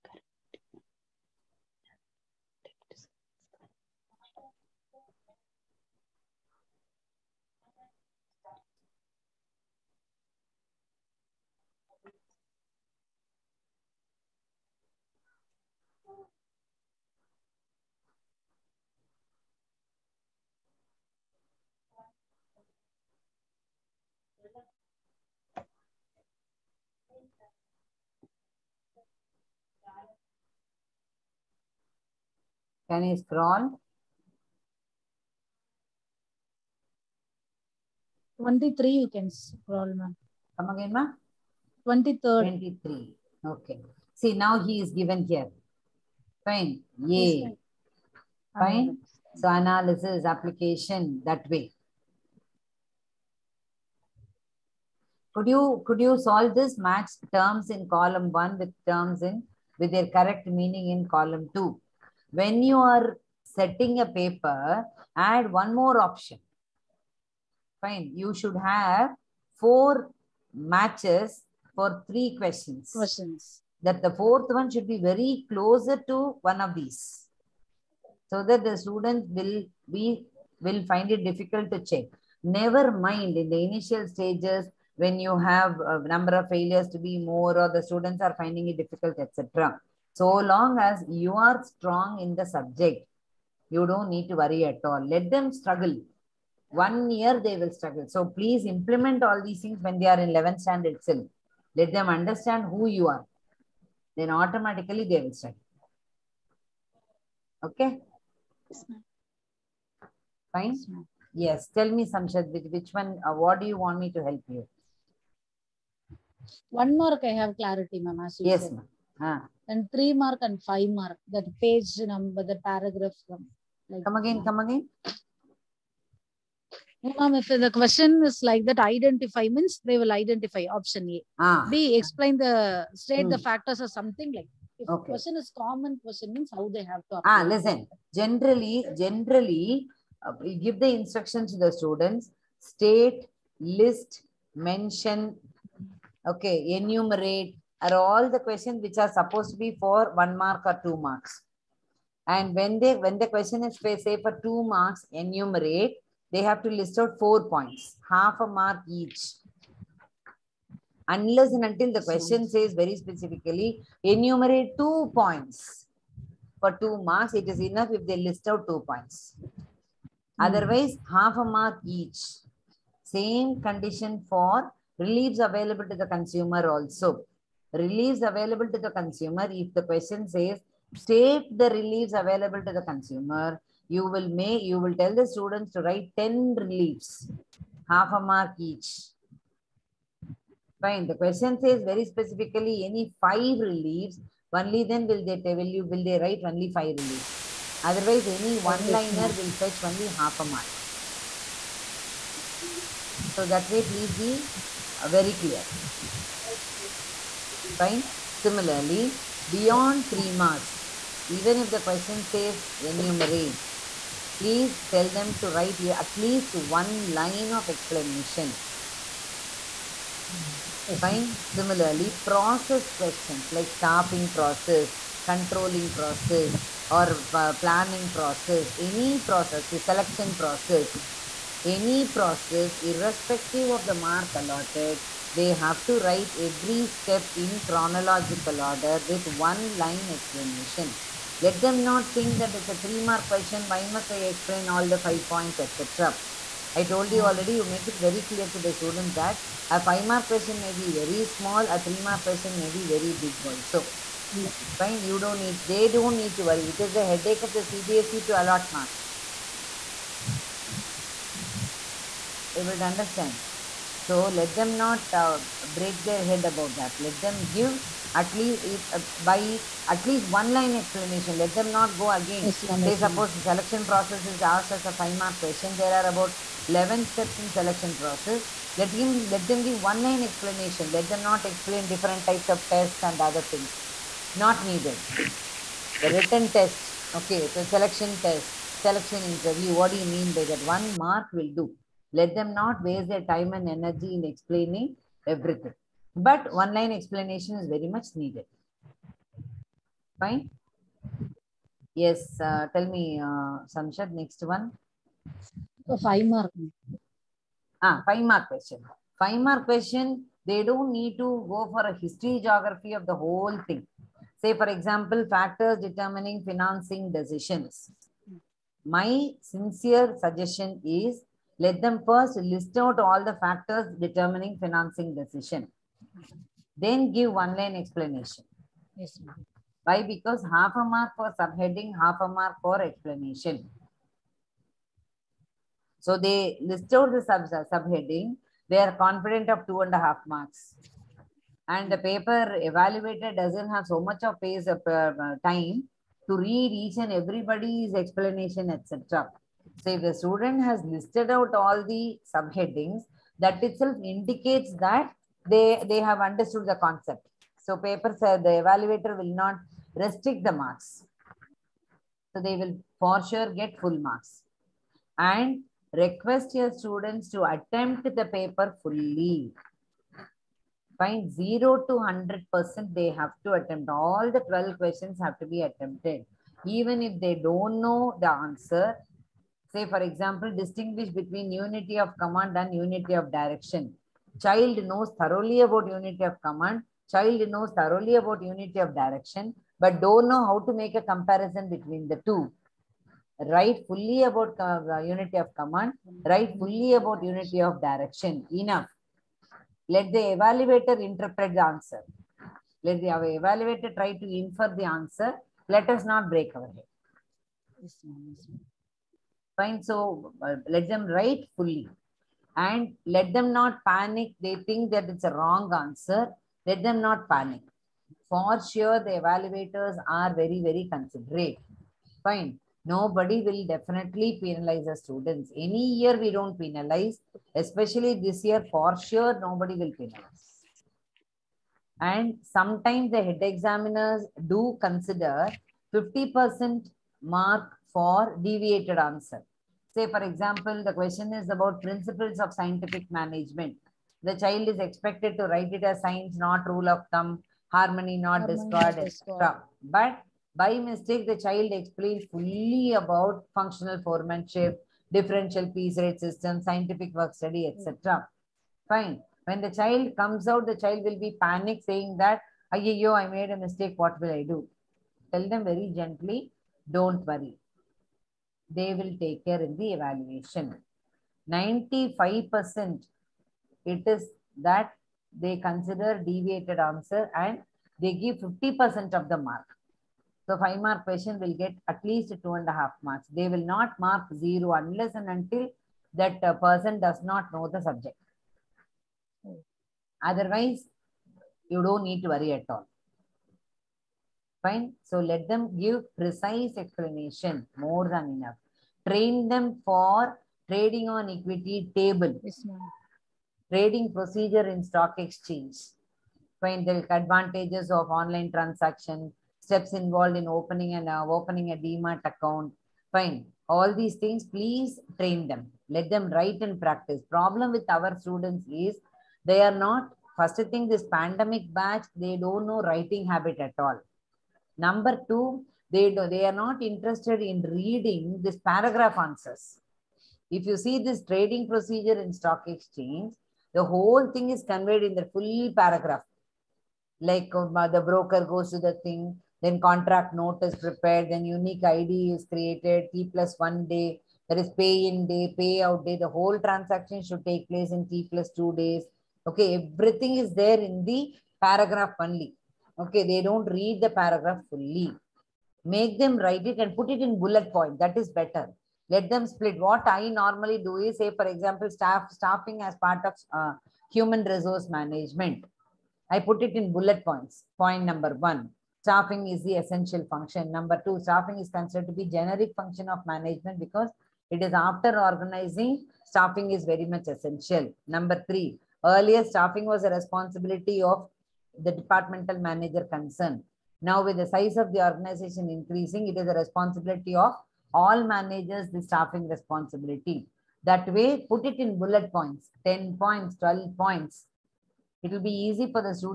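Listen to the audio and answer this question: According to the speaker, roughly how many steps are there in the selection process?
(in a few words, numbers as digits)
11.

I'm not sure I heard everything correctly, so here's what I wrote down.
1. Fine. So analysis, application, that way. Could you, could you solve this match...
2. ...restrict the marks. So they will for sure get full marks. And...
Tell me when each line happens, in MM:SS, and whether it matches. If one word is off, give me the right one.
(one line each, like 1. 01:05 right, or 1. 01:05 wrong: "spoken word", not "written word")
1. 00:48 right
2. 05:59 right.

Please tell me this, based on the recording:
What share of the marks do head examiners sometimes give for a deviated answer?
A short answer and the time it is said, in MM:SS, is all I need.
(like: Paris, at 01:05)
50%, at 07:15.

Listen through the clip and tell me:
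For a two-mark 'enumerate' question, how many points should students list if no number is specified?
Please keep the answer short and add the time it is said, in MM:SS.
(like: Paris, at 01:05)
4, at 02:37.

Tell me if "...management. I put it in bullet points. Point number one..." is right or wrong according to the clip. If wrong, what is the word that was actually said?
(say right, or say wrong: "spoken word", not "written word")
right.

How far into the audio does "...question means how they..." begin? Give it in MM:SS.
02:16.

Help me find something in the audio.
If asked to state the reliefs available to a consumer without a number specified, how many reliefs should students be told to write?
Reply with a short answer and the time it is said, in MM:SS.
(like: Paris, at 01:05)
10, at 03:06.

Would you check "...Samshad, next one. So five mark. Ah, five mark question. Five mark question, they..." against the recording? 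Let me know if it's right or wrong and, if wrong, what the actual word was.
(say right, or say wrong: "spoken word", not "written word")
right.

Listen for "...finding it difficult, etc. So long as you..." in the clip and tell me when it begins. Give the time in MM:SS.
01:28.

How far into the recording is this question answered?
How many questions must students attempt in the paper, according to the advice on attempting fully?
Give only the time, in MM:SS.
06:14.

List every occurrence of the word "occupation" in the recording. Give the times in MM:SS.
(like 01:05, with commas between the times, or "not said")
not said.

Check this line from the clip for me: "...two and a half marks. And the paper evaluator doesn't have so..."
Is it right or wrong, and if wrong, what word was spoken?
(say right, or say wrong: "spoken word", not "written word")
right.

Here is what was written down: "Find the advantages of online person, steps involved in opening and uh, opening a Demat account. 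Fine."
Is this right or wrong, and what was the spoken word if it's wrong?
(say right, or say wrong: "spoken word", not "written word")
wrong: "transaction", not "person".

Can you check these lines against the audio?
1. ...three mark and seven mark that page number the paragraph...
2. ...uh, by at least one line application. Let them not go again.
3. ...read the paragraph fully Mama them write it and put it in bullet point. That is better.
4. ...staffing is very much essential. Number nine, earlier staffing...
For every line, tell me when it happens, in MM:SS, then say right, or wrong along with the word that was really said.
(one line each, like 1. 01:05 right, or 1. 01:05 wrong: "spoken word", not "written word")
1. 01:59 wrong: "five", not "seven"
2. 04:28 wrong: "explanation", not "application"
3. 09:13 wrong: "Make", not "Mama"
4. 09:36 wrong: "three", not "nine".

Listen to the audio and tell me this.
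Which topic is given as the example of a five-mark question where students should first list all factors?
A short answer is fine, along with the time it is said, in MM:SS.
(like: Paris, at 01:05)
Factors determining financing decisions, at 05:15.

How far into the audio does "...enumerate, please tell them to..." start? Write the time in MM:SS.
03:32.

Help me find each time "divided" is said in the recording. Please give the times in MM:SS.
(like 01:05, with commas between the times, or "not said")
not said.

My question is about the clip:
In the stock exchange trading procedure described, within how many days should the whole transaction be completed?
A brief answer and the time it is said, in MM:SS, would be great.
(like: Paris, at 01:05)
T+2 days, at 09:08.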